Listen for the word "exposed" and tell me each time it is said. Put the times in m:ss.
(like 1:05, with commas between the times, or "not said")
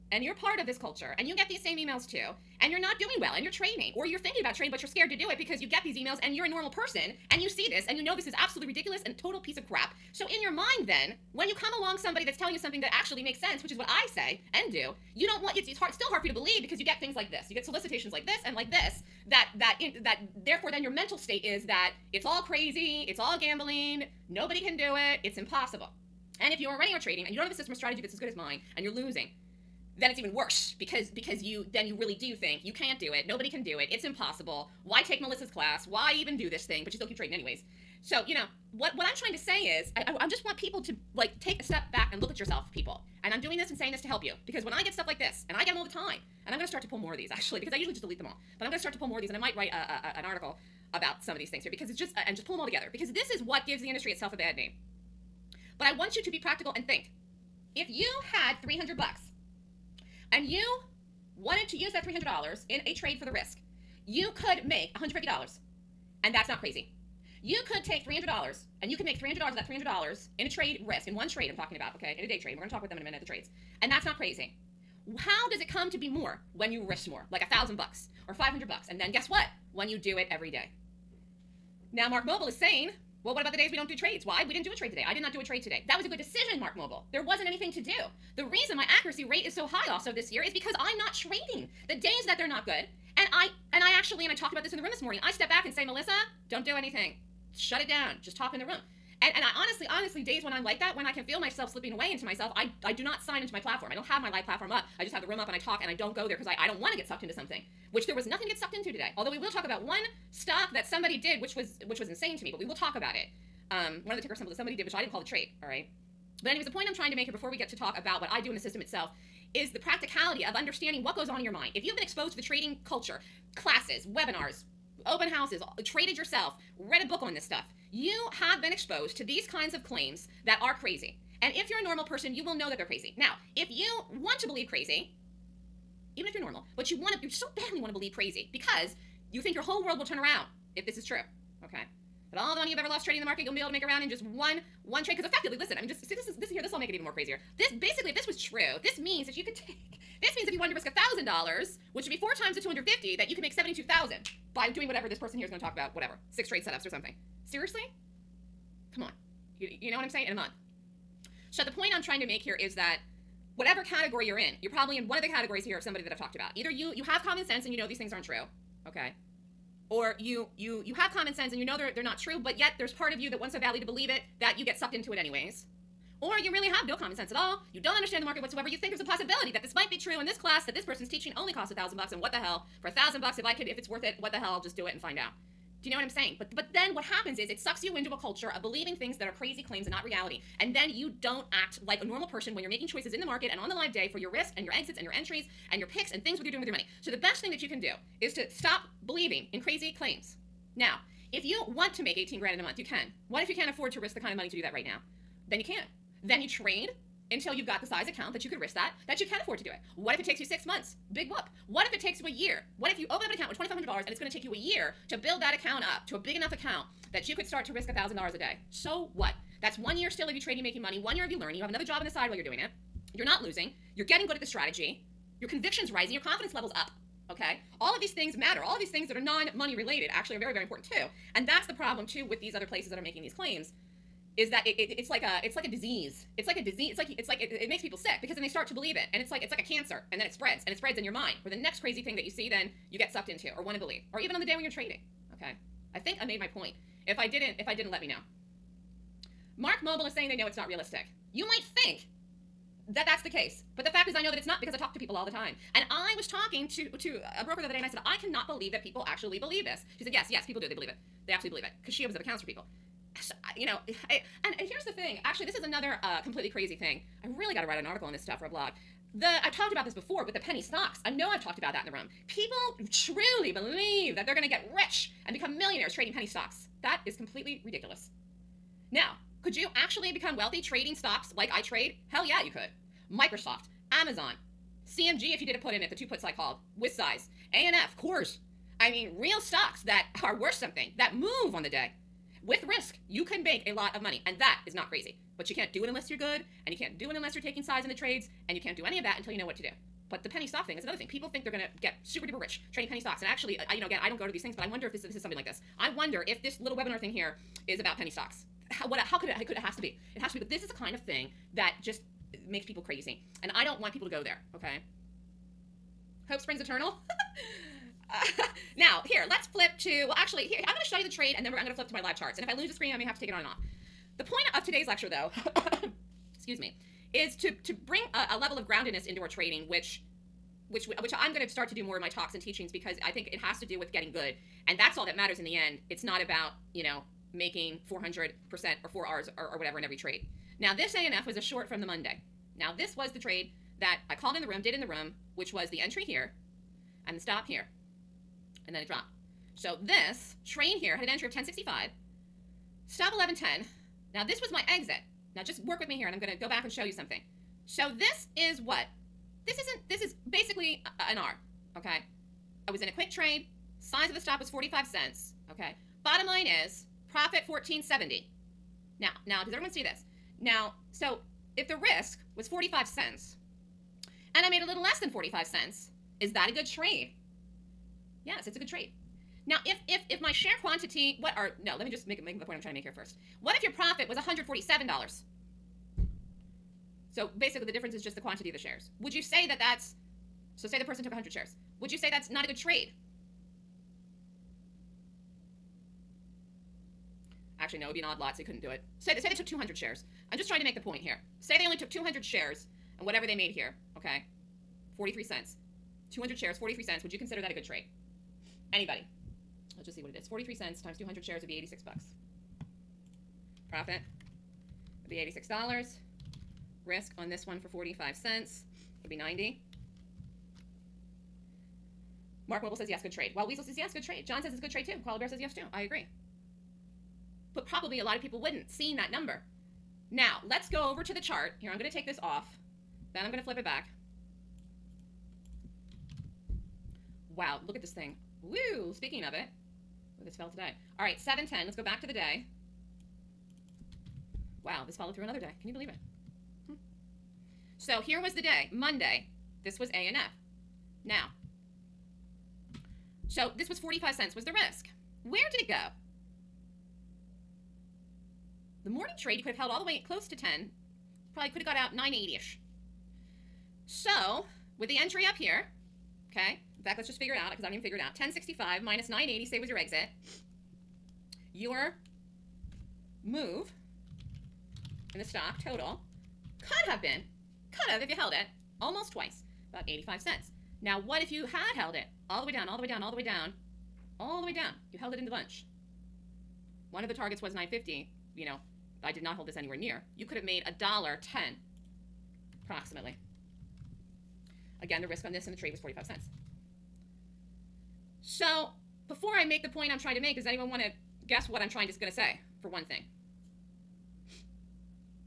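2:02, 2:08.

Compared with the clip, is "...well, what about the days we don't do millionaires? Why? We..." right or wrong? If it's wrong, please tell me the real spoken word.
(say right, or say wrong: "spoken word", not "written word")
wrong: "trades", not "millionaires".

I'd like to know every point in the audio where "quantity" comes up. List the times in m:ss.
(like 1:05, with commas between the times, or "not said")
6:20, 6:28.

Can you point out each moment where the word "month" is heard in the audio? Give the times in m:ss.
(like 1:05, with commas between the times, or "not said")
2:40, 3:22, 3:30.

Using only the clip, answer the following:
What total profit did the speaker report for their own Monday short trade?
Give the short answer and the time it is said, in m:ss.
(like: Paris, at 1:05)
1470, at 6:07.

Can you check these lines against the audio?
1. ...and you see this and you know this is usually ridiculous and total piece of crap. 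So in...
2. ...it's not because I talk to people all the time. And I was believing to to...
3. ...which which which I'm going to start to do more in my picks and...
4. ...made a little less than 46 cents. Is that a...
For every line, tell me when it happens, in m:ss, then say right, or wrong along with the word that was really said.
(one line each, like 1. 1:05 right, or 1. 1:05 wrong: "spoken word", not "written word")
1. 0:07 wrong: "absolutely", not "usually"
2. 4:14 wrong: "talking", not "believing"
3. 5:29 wrong: "talks", not "picks"
4. 6:14 wrong: "45", not "46".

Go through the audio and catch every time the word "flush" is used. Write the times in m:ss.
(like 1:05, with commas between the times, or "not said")
not said.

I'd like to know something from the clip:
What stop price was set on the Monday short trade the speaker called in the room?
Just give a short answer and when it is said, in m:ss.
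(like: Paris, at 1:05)
11.10, at 5:53.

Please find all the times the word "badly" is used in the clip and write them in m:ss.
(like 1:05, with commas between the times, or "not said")
2:17, 2:53.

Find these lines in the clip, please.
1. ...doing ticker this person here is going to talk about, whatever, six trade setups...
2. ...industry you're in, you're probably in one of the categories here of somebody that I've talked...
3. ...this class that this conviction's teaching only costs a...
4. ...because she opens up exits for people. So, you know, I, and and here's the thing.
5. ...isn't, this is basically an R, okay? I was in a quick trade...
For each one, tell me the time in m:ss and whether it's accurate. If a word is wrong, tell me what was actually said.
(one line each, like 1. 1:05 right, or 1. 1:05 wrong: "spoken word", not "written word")
1. 2:34 wrong: "whatever", not "ticker"
2. 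2:43 wrong: "category", not "industry"
3. 3:00 wrong: "person", not "conviction"
4. 4:21 wrong: "accounts", not "exits"
5. 5:59 right.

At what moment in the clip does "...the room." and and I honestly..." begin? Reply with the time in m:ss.
1:38.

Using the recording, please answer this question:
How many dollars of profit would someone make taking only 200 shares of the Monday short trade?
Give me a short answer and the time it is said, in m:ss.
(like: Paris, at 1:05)
$86, at 6:51.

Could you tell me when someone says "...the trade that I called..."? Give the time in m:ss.
5:43.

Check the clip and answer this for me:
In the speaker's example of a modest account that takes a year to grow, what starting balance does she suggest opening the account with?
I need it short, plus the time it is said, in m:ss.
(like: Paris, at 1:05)
$2,500, at 3:33.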